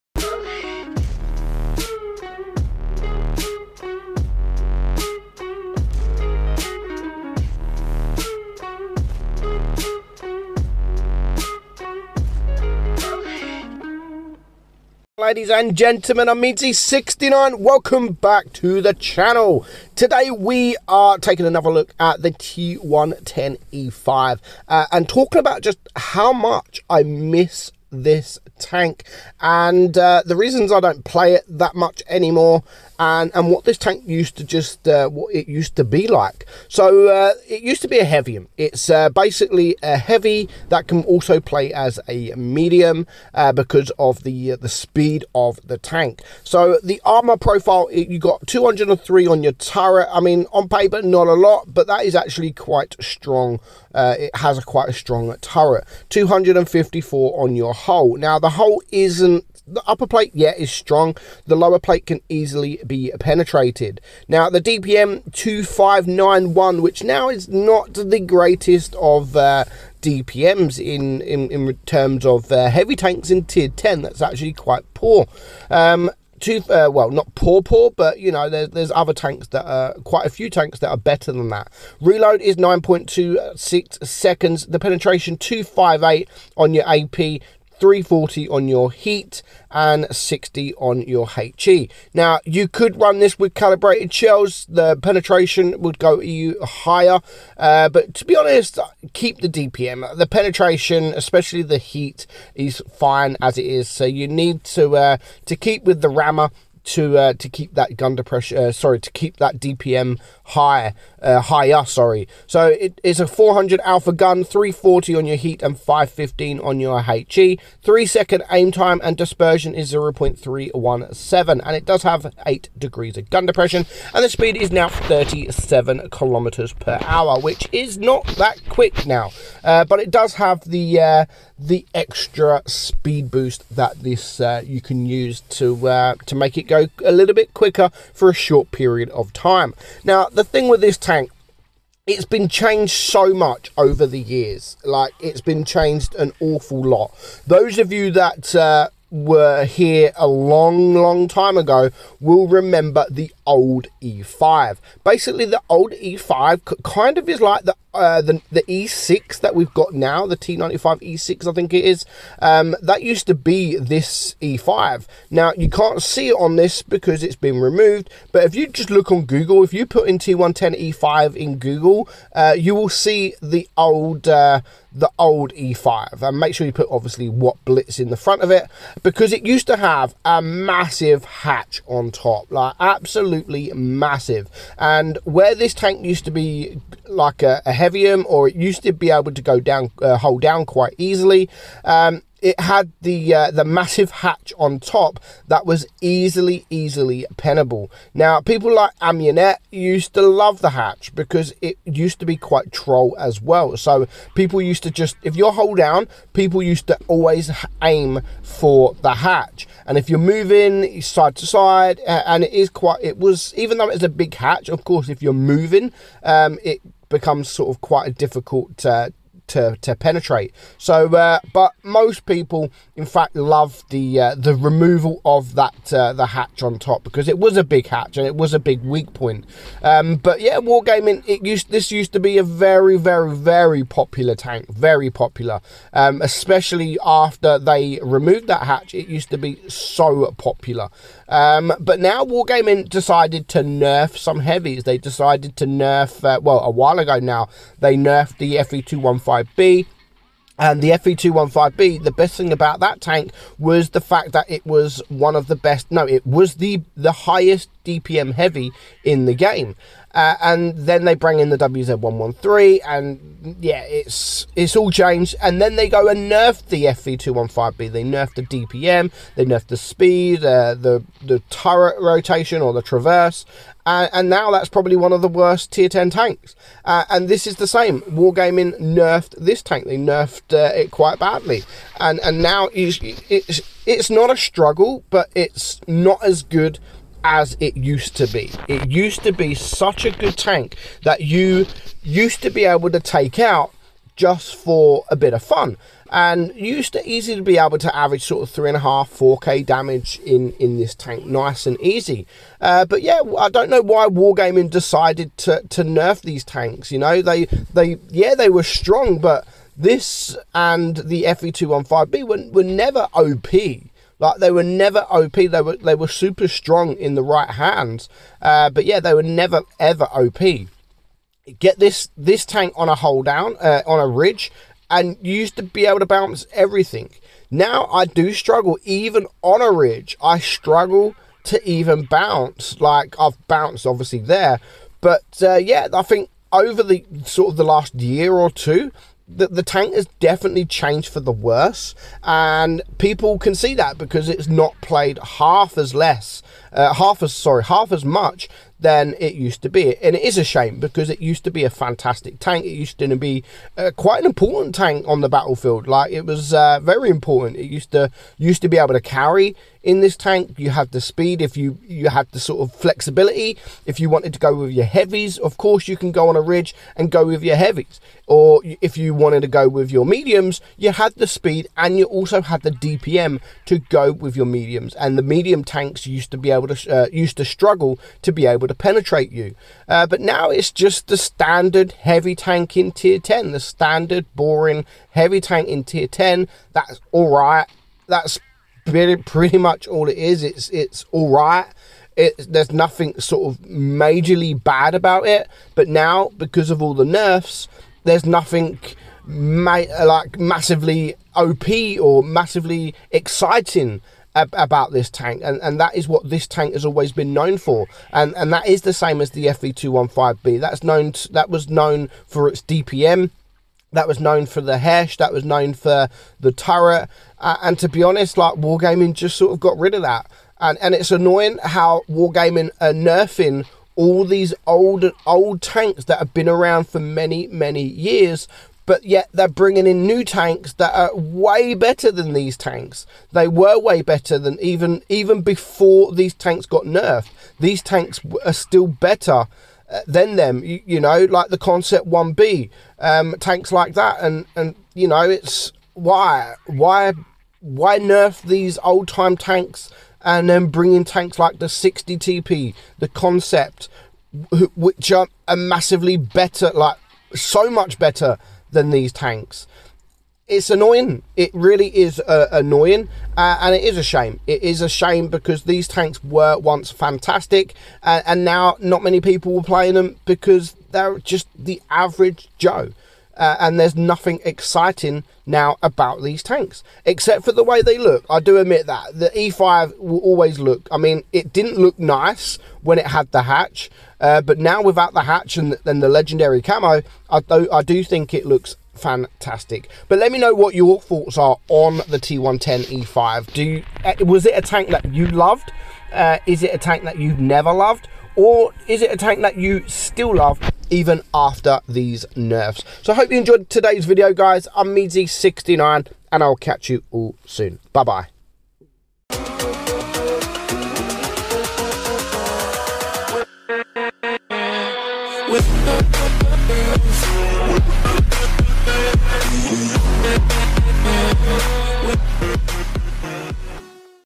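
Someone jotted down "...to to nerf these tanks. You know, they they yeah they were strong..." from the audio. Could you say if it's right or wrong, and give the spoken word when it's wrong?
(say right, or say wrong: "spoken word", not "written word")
right.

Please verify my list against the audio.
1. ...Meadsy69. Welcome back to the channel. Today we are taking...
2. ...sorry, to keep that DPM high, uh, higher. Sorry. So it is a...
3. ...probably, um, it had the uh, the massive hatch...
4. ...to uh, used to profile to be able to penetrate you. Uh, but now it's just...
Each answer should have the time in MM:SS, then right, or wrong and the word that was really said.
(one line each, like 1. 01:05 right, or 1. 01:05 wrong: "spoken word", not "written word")
1. 00:16 right
2. 01:48 right
3. 03:10 wrong: "easily", not "probably"
4. 06:16 wrong: "struggle", not "profile".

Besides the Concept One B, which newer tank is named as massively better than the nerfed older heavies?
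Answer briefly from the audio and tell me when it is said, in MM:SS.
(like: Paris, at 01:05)
60 TP, at 07:31.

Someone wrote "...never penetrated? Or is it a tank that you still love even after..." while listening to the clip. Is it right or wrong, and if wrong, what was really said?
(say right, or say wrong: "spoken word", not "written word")
wrong: "loved", not "penetrated".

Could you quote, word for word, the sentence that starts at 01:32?
Now, you could run this with calibrated shells.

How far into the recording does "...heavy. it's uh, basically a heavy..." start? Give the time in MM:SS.
00:38.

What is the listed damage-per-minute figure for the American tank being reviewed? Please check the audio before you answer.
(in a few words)
2591.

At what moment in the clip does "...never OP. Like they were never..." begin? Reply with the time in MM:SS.
05:12.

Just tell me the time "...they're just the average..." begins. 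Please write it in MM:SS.
07:50.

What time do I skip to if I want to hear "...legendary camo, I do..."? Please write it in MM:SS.
08:06.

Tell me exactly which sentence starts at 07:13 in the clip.
They were way better than even even before these tanks got nerfed.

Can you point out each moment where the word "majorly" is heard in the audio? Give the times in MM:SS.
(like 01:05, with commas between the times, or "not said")
06:33.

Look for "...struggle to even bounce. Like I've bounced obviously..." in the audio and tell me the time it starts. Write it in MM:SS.
05:30.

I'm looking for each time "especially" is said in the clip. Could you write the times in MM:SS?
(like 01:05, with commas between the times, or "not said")
01:41, 03:56.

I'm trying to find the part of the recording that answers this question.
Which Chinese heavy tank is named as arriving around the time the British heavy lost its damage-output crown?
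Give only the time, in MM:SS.
04:21.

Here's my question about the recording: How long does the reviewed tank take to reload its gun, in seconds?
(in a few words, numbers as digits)
9.26 seconds.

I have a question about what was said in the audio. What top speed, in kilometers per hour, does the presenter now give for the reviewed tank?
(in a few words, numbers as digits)
37.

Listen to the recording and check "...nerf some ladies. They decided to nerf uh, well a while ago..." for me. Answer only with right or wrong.
wrong.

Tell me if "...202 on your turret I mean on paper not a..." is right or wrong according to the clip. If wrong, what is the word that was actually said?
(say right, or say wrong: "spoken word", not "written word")
wrong: "203", not "202".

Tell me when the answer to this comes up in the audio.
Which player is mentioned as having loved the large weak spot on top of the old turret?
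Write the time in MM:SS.
03:18.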